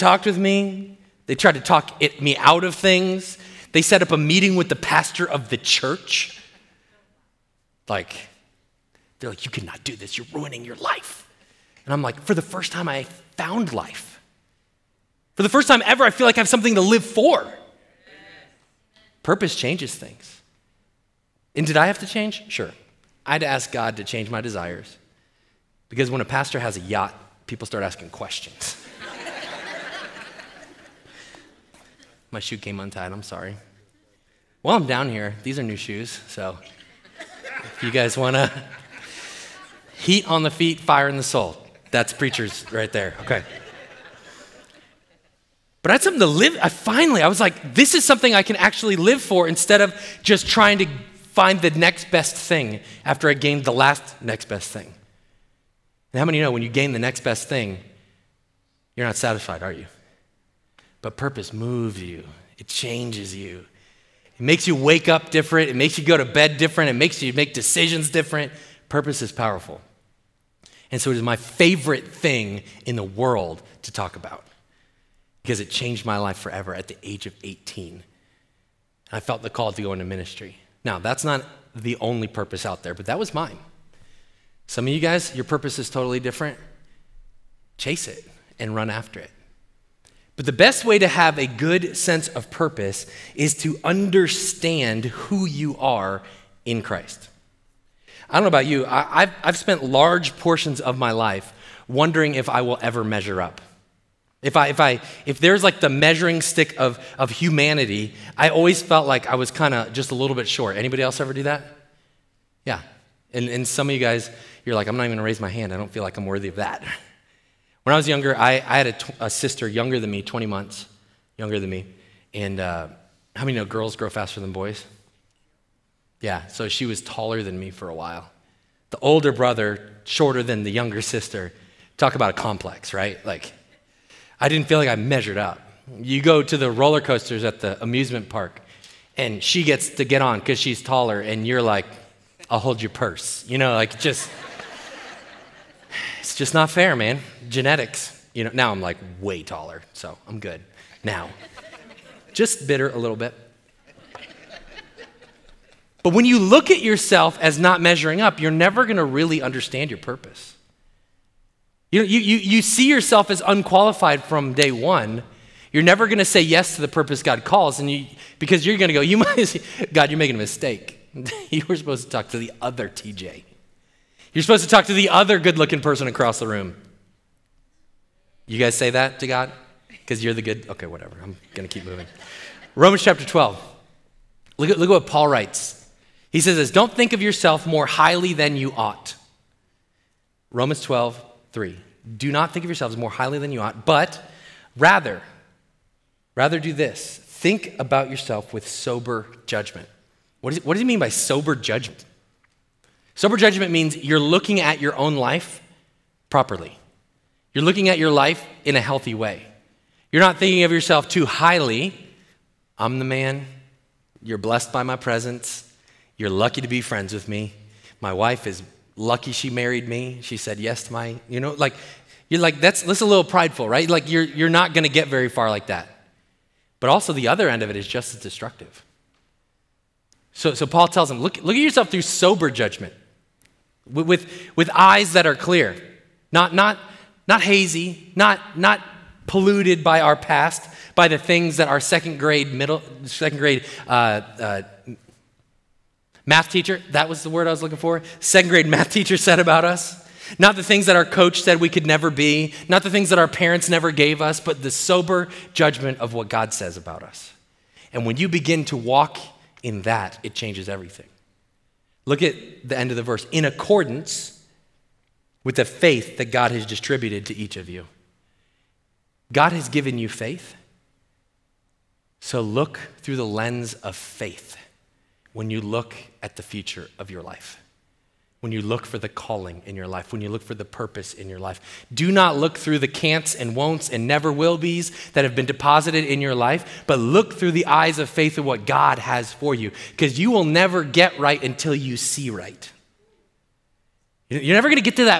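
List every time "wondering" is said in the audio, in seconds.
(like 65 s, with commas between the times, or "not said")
101 s.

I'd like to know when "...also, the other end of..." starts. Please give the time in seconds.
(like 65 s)
226 s.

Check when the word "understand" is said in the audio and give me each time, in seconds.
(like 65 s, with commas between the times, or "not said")
93 s, 159 s.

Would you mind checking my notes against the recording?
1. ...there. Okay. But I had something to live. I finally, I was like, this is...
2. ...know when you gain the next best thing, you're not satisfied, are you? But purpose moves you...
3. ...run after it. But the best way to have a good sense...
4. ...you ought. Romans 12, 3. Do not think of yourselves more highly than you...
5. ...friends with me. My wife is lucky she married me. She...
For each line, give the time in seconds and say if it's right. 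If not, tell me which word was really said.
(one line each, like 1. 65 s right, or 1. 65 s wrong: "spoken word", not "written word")
1. 42 s right
2. 56 s right
3. 88 s right
4. 188 s right
5. 216 s right.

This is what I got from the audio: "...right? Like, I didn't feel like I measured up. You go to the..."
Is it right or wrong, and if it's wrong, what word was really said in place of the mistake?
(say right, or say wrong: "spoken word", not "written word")
right.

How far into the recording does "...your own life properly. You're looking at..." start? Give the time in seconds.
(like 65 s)
204 s.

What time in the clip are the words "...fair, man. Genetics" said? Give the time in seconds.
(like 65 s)
146 s.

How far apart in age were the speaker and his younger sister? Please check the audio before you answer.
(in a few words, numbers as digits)
20 months.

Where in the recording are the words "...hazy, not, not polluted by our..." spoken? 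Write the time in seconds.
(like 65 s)
237 s.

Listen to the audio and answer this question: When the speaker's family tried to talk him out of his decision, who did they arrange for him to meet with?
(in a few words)
The pastor of the church.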